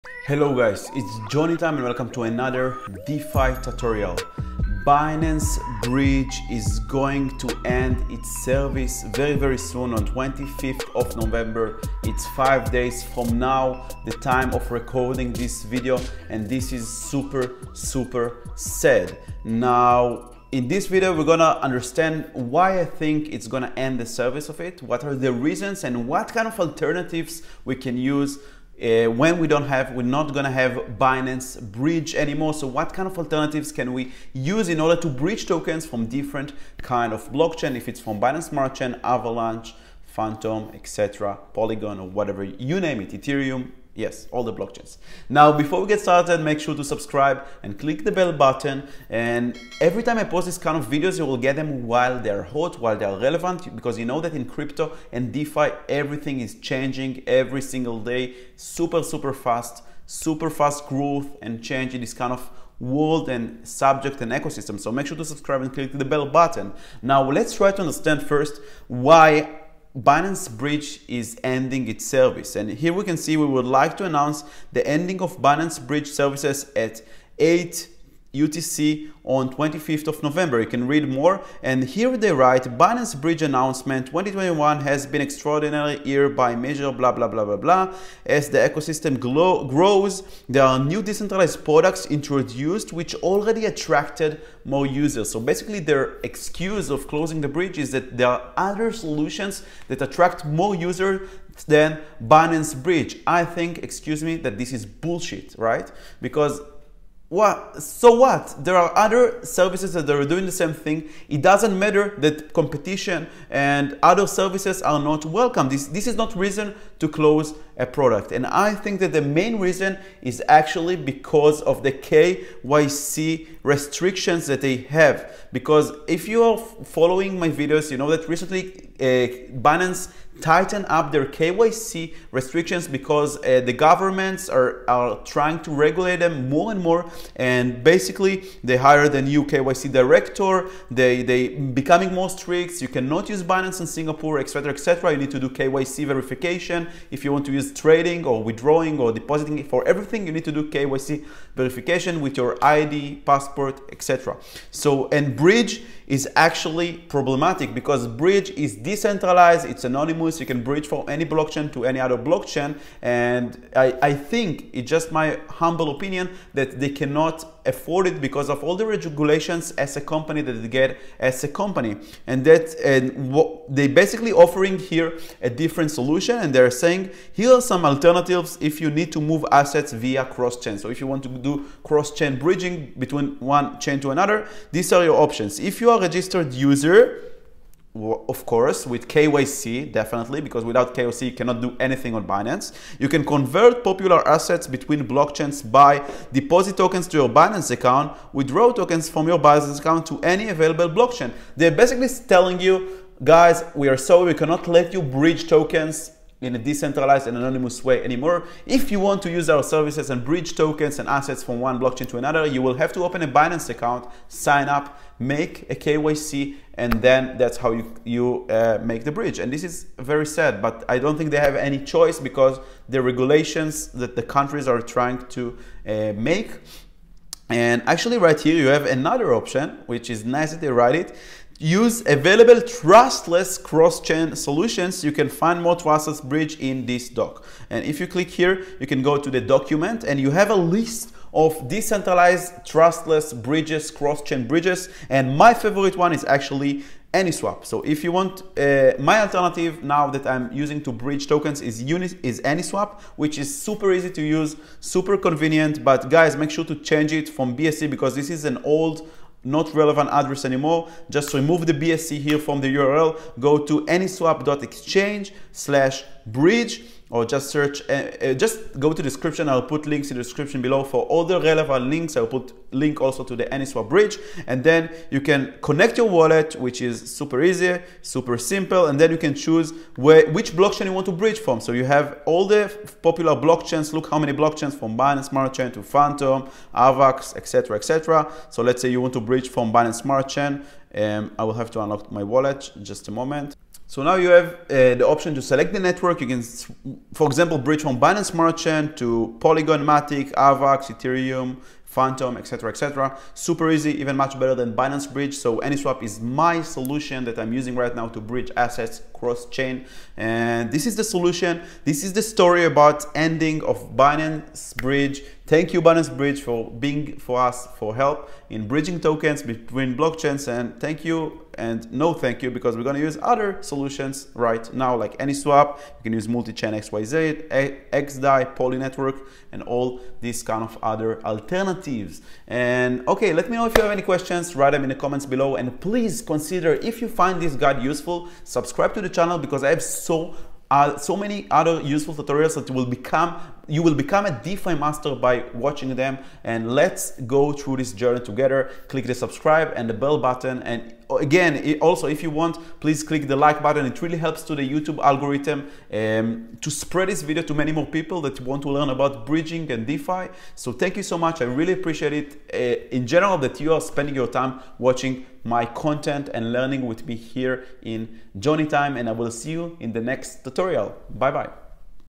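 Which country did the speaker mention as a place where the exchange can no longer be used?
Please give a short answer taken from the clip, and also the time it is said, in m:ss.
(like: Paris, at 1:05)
Singapore, at 2:23.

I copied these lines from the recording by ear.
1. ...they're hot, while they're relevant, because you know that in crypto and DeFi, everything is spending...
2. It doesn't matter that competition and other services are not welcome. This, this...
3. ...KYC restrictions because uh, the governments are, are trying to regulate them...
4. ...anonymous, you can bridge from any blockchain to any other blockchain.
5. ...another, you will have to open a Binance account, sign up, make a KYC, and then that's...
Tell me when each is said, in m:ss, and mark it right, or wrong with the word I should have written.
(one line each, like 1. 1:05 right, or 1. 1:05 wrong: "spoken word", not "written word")
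1. 0:52 wrong: "changing", not "spending"
2. 1:51 right
3. 2:11 right
4. 2:39 right
5. 3:32 right.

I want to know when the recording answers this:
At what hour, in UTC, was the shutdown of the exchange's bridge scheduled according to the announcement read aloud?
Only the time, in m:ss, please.
1:17.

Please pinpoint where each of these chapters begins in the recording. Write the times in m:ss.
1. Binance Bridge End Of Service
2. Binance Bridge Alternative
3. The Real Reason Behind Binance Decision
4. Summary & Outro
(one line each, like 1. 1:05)
1. 1:00
2. 3:45
3. 1:40
4. 5:30.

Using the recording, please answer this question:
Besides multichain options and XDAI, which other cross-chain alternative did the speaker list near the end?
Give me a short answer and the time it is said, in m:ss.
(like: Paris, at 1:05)
Poly Network, at 5:28.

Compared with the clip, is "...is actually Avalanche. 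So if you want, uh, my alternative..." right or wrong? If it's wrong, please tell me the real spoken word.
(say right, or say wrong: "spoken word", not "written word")
wrong: "AnySwap", not "Avalanche".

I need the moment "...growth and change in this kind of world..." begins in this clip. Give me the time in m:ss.
1:00.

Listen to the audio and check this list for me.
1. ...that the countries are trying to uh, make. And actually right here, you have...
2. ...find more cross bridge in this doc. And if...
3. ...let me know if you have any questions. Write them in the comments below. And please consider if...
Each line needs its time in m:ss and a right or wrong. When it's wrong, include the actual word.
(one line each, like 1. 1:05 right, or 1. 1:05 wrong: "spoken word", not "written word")
1. 3:43 right
2. 3:55 wrong: "trustless", not "cross"
3. 5:33 right.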